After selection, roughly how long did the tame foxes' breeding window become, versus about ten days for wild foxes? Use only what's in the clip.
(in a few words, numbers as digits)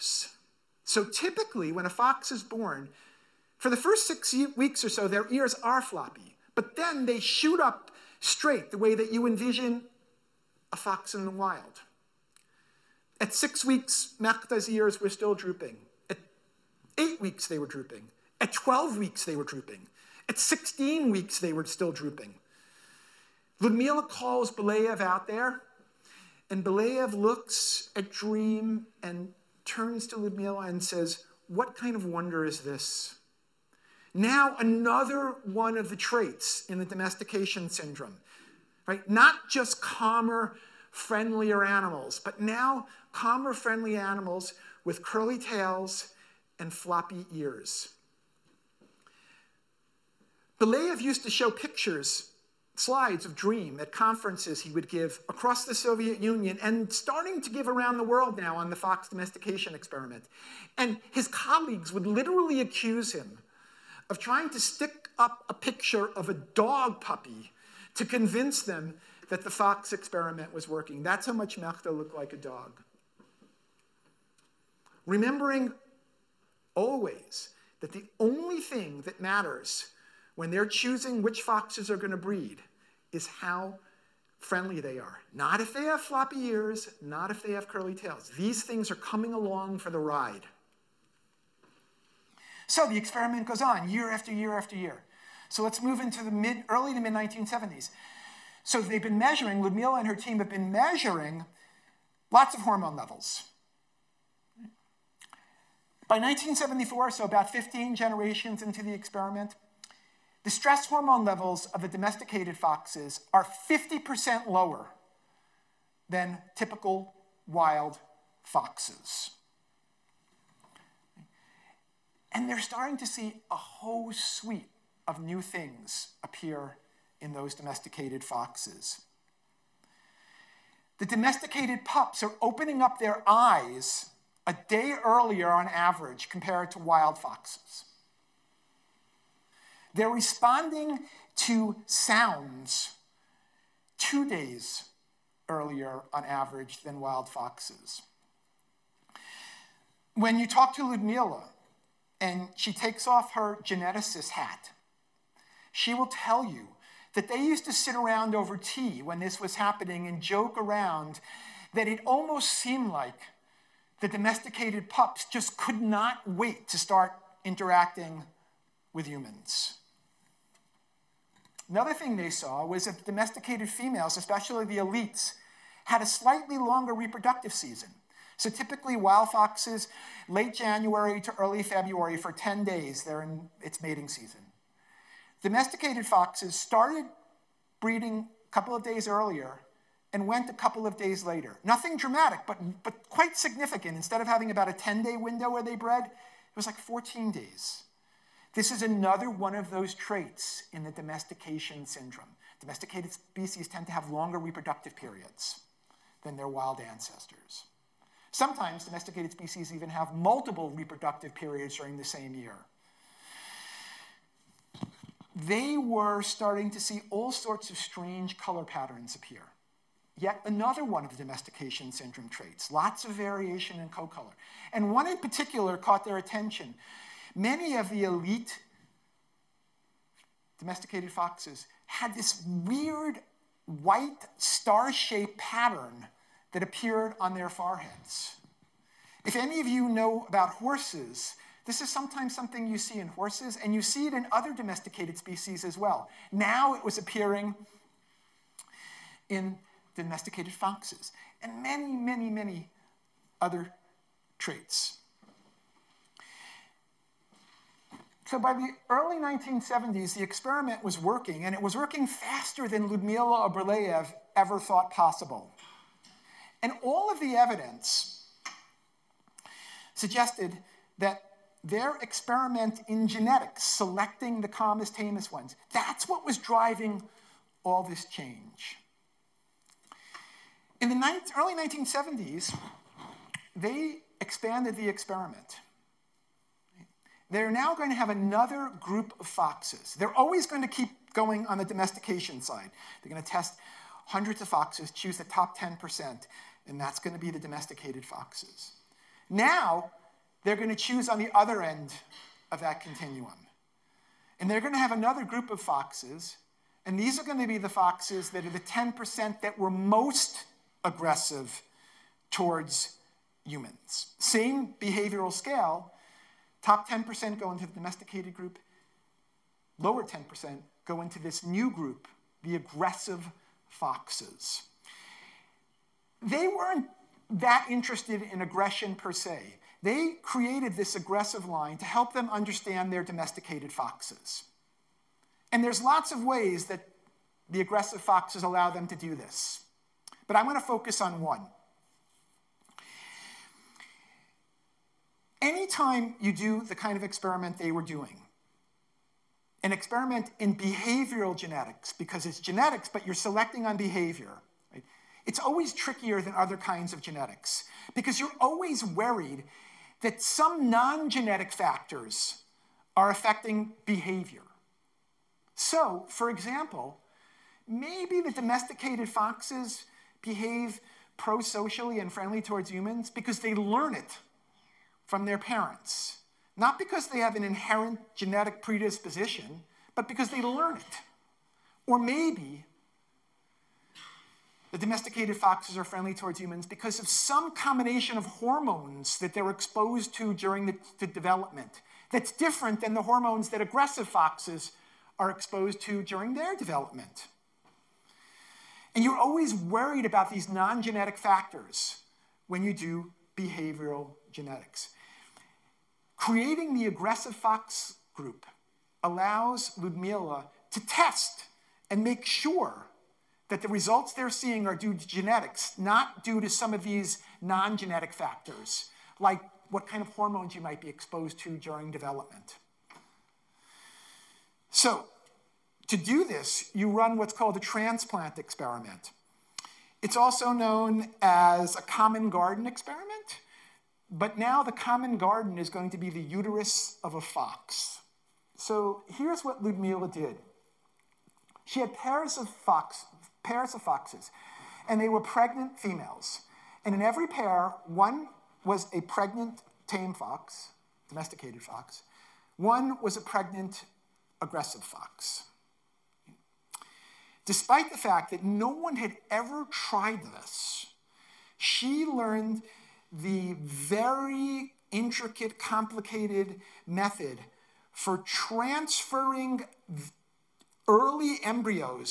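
14 days.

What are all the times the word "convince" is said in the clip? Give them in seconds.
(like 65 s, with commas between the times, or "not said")
68 s.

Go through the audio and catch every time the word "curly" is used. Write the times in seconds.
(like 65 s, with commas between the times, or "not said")
45 s, 87 s.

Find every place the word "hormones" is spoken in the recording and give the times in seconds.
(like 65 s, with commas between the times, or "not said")
102 s, 110 s, 388 s, 393 s, 420 s.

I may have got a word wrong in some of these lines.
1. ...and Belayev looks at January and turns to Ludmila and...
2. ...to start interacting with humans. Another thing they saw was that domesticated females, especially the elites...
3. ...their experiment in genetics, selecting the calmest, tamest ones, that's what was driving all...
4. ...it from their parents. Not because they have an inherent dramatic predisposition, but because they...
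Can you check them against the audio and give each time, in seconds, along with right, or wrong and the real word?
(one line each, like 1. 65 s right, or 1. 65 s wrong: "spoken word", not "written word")
1. 26 s wrong: "Dream", not "January"
2. 166 s right
3. 271 s right
4. 373 s wrong: "genetic", not "dramatic".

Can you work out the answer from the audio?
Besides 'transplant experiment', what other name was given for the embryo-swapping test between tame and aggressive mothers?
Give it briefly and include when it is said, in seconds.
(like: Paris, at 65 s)
common garden experiment, at 431 s.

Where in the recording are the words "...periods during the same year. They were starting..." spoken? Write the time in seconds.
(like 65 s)
211 s.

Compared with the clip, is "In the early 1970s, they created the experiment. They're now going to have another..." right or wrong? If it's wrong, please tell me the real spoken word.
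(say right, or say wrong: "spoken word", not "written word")
wrong: "expanded", not "created".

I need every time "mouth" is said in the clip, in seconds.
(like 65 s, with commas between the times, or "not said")
not said.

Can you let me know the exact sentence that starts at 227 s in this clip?
Many of the elite domesticated foxes had this weird white star-shaped pattern that appeared on their foreheads.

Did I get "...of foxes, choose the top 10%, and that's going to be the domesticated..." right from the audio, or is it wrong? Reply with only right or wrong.
right.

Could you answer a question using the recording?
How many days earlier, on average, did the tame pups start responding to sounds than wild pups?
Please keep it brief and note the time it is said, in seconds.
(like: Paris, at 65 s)
two days, at 143 s.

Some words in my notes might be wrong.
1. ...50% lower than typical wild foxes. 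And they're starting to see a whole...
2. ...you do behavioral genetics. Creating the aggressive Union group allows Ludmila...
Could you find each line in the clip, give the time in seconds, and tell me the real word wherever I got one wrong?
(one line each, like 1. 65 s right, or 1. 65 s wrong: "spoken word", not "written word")
1. 113 s right
2. 402 s wrong: "Fox", not "Union".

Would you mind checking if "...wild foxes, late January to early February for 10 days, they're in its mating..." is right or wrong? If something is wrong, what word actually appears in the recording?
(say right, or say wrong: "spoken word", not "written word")
right.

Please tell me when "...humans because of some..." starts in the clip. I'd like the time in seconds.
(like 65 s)
386 s.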